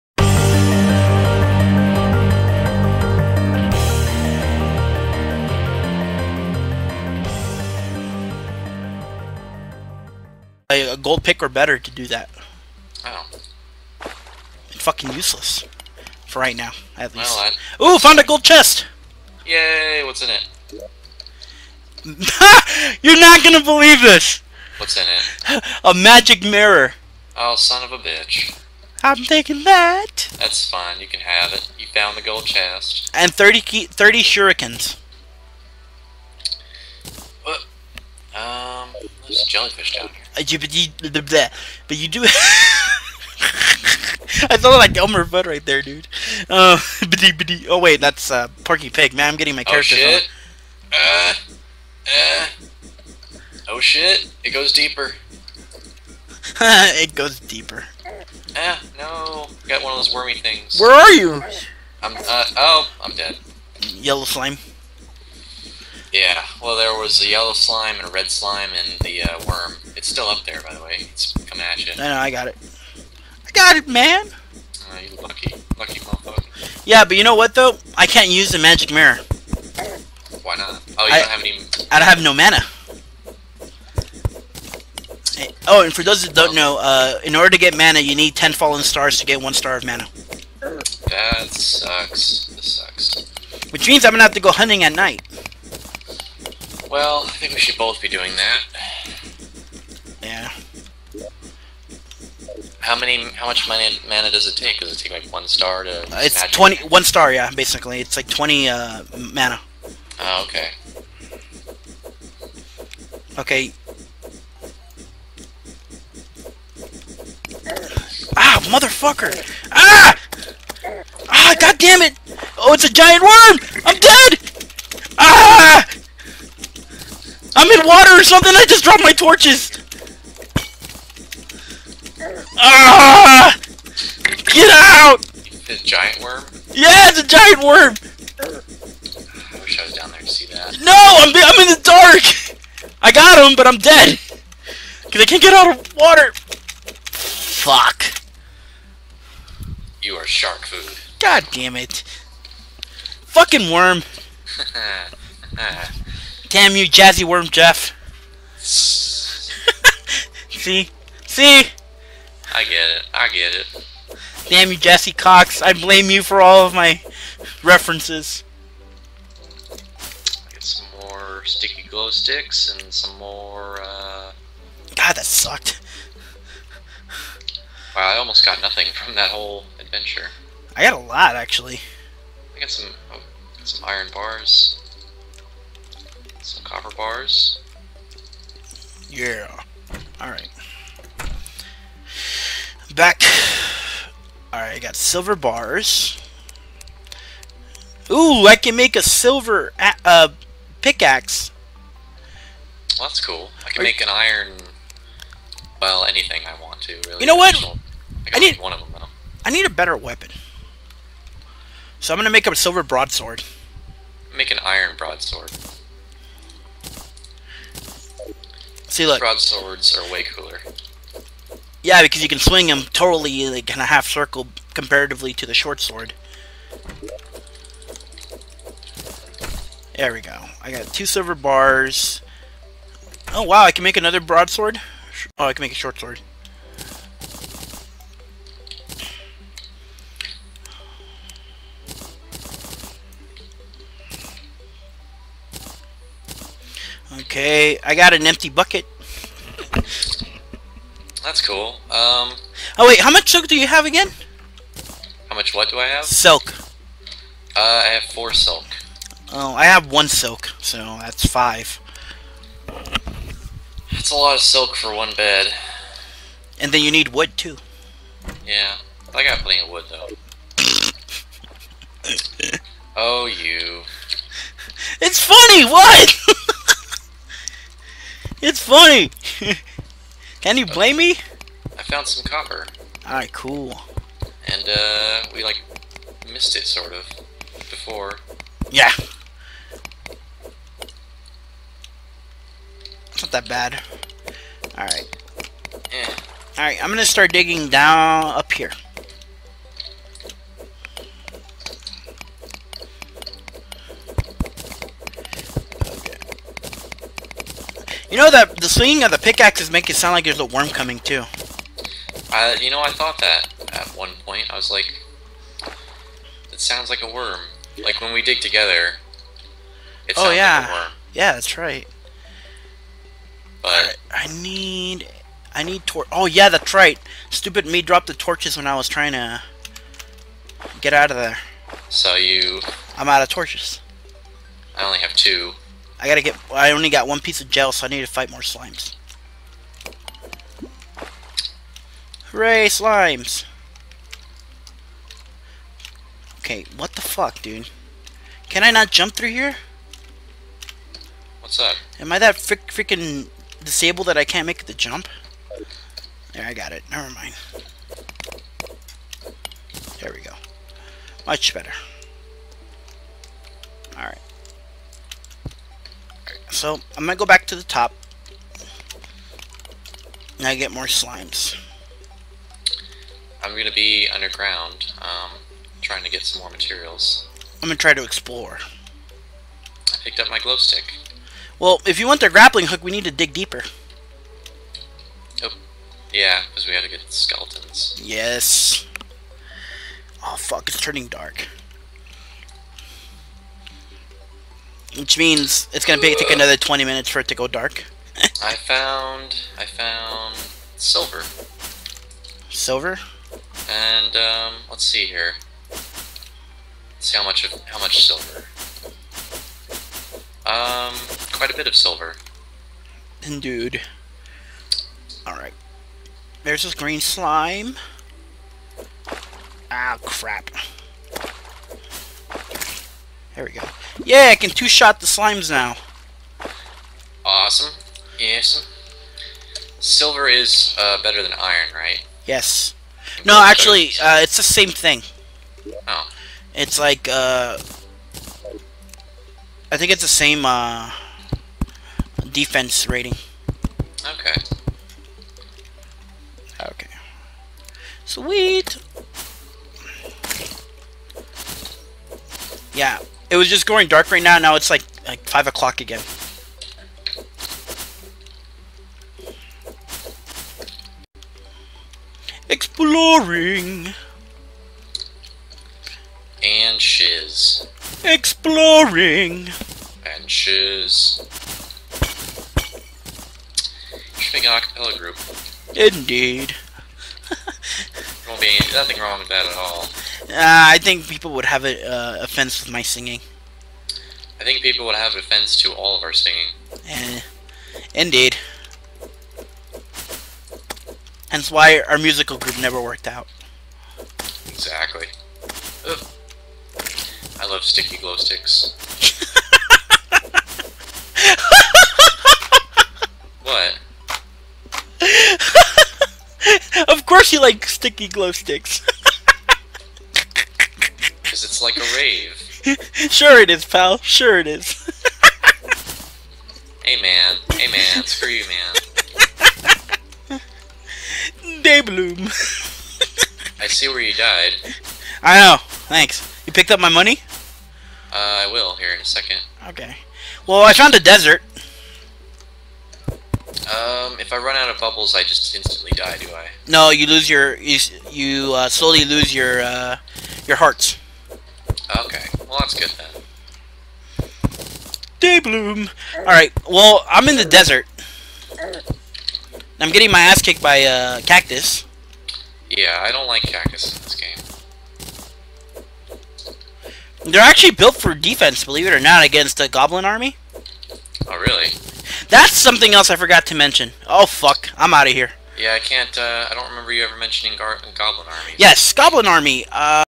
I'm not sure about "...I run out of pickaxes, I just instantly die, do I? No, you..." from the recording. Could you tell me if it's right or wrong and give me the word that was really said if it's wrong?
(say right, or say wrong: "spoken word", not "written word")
wrong: "bubbles", not "pickaxes".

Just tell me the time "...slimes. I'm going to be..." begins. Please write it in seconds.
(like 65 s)
370 s.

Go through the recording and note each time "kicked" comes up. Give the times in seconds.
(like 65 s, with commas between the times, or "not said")
550 s.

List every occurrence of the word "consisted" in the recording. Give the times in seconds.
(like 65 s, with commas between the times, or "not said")
not said.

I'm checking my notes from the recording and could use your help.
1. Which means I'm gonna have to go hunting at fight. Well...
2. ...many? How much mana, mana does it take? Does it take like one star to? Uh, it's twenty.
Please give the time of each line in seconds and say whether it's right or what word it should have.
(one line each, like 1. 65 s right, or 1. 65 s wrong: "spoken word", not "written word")
1. 93 s wrong: "night", not "fight"
2. 102 s right.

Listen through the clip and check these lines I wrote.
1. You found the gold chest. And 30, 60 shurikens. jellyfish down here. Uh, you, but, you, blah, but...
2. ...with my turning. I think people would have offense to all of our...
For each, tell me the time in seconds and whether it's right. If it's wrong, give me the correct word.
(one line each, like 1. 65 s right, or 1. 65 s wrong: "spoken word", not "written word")
1. 31 s wrong: "30", not "60"
2. 482 s wrong: "singing", not "turning".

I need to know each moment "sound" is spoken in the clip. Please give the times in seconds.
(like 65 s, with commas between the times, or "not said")
309 s, 316 s.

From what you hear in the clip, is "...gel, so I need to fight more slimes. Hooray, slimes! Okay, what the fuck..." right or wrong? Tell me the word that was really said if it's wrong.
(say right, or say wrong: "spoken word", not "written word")
right.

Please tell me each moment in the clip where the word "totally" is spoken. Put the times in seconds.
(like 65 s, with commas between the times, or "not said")
222 s.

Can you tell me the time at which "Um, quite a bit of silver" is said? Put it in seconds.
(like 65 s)
410 s.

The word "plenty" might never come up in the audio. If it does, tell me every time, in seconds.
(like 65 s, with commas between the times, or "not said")
269 s.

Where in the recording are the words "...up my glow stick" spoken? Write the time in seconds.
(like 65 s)
380 s.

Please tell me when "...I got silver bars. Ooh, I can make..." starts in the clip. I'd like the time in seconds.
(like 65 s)
194 s.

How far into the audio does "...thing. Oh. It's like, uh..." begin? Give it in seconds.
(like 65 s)
434 s.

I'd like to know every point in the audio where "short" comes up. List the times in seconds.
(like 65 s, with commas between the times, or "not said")
225 s, 235 s.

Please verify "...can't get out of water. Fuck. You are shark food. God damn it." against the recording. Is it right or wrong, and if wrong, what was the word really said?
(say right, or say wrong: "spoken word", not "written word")
right.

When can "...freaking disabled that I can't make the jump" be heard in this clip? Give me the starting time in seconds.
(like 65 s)
352 s.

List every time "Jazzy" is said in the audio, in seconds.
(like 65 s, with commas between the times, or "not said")
156 s.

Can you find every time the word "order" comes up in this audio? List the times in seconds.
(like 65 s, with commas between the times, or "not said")
87 s.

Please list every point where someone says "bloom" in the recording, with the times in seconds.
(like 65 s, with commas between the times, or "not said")
521 s, 545 s.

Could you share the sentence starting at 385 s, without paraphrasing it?
Oh, yeah, because we had to get skeletons.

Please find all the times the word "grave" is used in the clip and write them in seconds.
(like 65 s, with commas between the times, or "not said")
512 s.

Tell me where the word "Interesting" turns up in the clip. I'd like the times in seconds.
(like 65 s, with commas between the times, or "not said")
474 s.